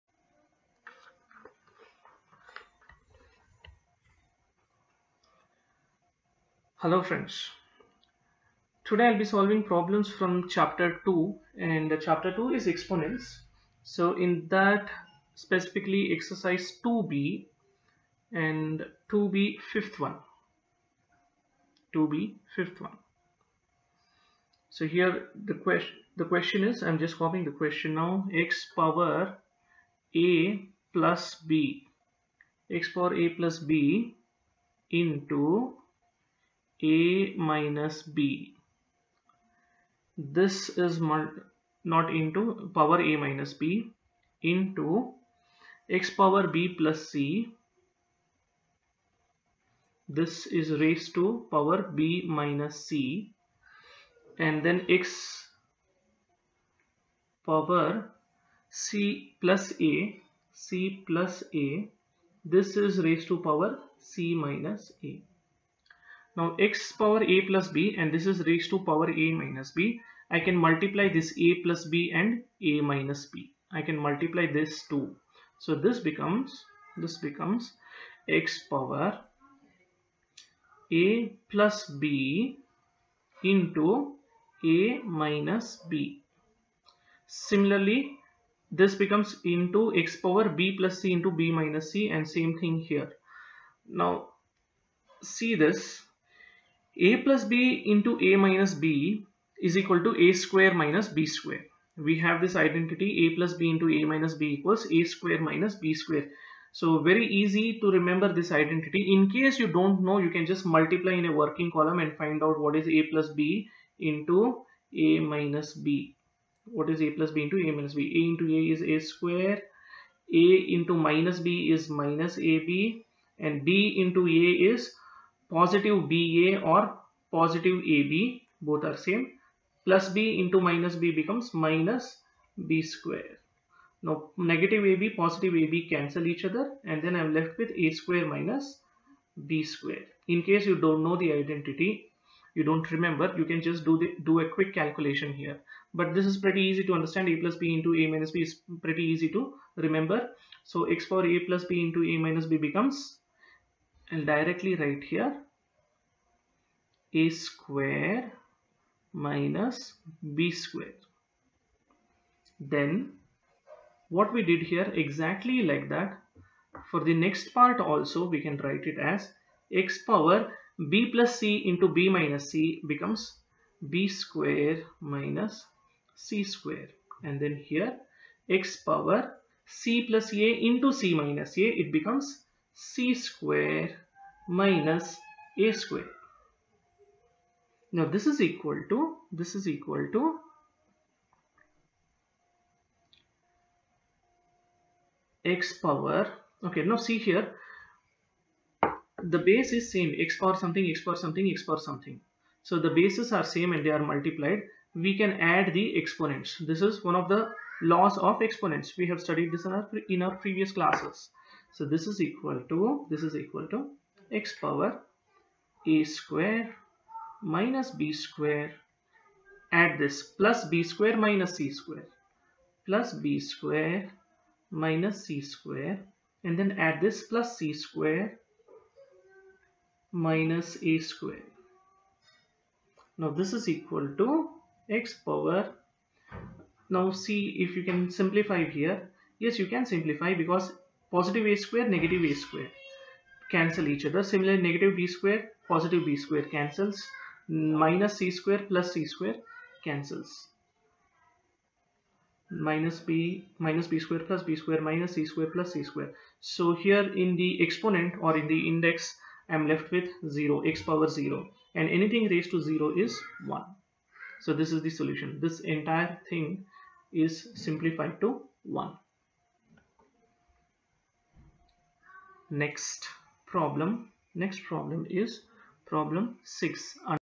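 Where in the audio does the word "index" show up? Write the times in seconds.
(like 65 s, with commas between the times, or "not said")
258 s.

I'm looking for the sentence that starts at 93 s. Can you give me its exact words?
Now see this a plus b into a minus b is equal to a square minus b square.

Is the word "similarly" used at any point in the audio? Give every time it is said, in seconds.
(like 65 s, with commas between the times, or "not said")
87 s, 244 s.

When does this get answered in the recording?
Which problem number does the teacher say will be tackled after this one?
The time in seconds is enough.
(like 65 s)
275 s.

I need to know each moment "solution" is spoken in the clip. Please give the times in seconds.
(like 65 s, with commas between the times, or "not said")
264 s.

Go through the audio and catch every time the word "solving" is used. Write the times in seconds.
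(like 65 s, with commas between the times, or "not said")
9 s.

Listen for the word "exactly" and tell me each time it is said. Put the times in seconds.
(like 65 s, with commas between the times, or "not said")
165 s.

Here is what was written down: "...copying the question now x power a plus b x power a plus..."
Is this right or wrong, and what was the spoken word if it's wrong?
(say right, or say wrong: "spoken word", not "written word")
right.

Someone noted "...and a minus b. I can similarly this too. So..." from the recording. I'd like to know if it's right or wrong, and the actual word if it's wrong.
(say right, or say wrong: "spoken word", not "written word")
wrong: "multiply", not "similarly".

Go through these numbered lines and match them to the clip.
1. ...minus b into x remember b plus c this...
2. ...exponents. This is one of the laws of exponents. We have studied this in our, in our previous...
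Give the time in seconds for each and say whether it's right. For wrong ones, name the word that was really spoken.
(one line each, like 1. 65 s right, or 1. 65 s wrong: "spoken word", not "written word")
1. 43 s wrong: "power", not "remember"
2. 205 s right.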